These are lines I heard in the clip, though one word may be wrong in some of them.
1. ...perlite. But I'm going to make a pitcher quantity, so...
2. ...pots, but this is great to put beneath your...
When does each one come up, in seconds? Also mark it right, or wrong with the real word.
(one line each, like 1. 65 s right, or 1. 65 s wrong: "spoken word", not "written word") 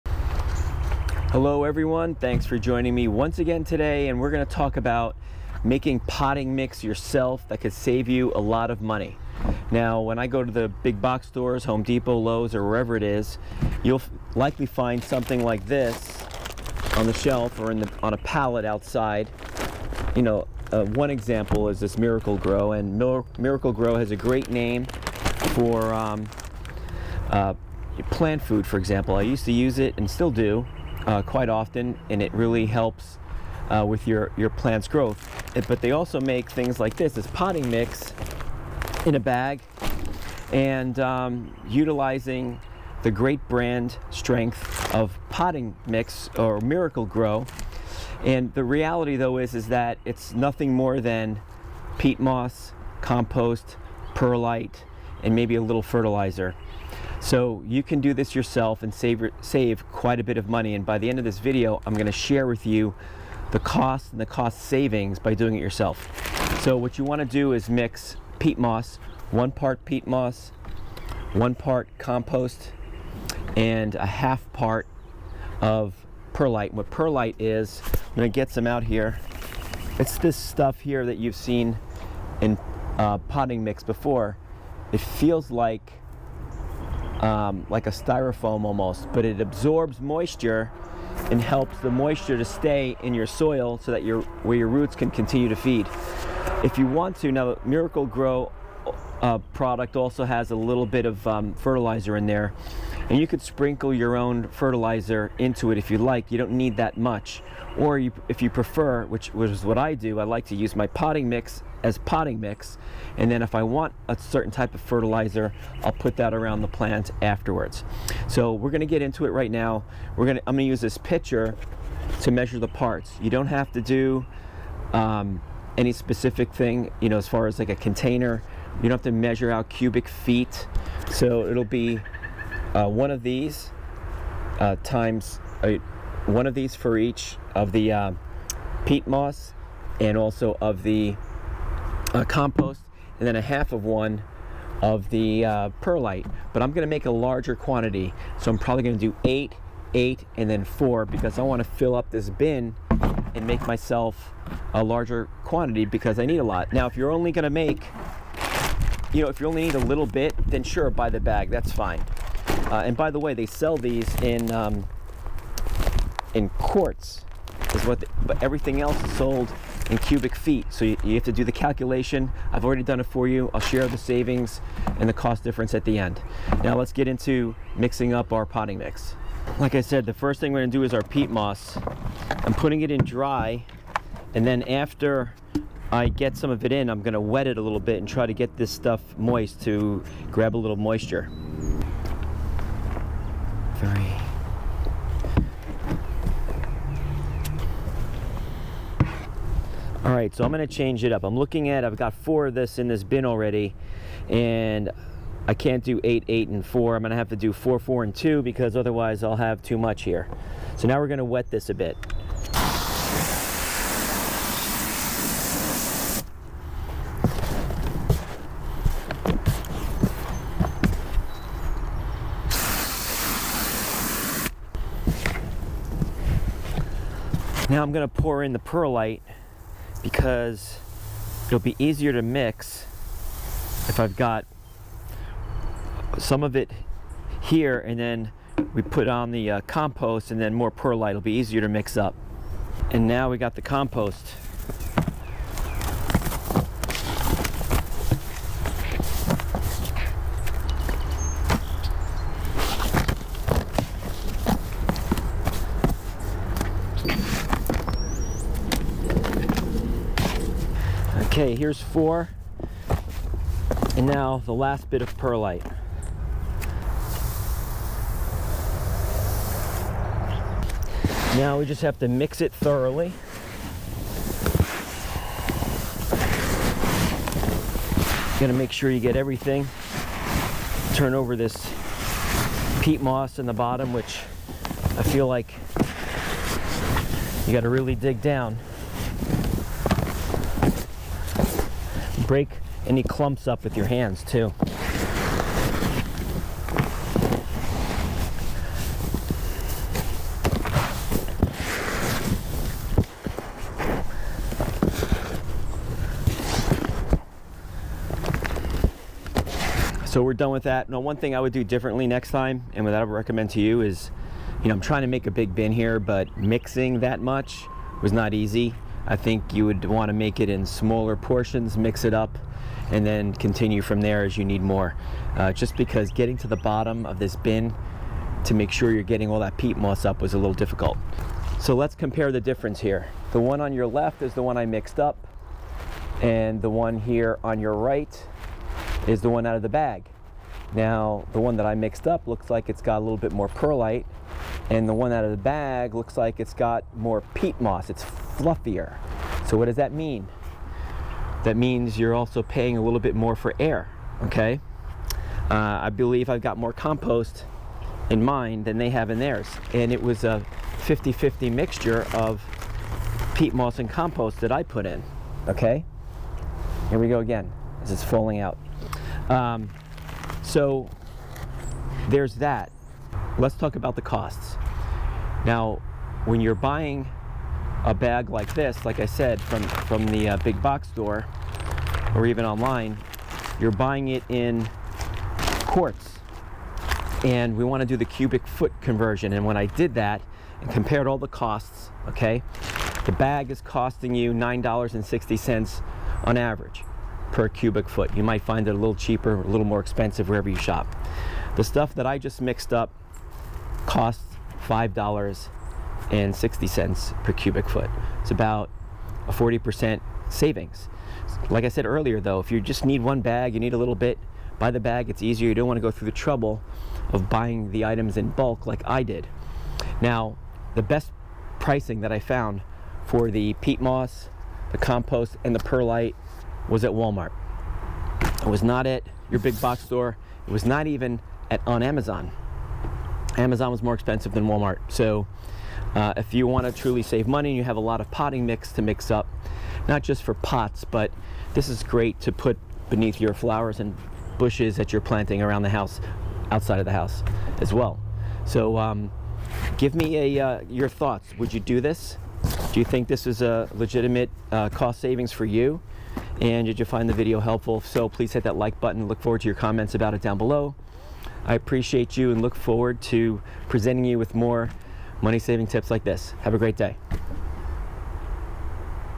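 1. 145 s wrong: "larger", not "pitcher"
2. 440 s right.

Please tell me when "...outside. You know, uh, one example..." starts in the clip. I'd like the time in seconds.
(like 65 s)
18 s.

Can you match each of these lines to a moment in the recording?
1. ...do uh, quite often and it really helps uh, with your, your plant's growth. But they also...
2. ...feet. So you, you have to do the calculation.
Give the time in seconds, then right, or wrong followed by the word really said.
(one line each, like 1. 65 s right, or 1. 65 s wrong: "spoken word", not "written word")
1. 30 s right
2. 170 s right.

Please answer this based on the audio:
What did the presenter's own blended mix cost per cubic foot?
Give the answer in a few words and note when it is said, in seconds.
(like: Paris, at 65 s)
$5.60, at 404 s.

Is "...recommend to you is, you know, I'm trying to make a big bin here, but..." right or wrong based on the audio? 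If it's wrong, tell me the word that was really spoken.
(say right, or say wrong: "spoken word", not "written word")
right.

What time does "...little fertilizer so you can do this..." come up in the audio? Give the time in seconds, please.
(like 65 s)
55 s.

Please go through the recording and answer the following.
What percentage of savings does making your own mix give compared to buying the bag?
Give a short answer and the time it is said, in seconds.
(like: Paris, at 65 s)
40%, at 409 s.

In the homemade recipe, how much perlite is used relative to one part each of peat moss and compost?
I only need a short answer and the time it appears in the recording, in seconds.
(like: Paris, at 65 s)
a half part, at 73 s.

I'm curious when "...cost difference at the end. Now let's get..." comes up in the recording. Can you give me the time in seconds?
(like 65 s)
175 s.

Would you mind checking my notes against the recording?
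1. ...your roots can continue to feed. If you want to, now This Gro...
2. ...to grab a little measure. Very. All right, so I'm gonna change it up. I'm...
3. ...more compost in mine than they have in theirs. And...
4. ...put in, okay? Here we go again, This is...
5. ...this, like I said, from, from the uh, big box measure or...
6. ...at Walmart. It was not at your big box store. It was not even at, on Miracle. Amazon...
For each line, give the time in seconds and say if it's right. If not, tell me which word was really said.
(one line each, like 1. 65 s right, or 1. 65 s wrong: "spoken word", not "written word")
1. 94 s wrong: "Miracle", not "This"
2. 189 s wrong: "moisture", not "measure"
3. 356 s right
4. 364 s right
5. 378 s wrong: "store", not "measure"
6. 426 s wrong: "Amazon", not "Miracle".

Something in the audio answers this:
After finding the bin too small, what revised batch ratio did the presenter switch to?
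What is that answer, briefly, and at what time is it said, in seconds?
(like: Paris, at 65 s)
4, 4, and 2, at 207 s.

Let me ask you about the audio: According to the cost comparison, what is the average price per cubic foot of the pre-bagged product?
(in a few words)
$9.60.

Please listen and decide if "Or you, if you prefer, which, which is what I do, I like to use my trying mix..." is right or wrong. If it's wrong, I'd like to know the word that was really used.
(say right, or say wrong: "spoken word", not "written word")
wrong: "potting", not "trying".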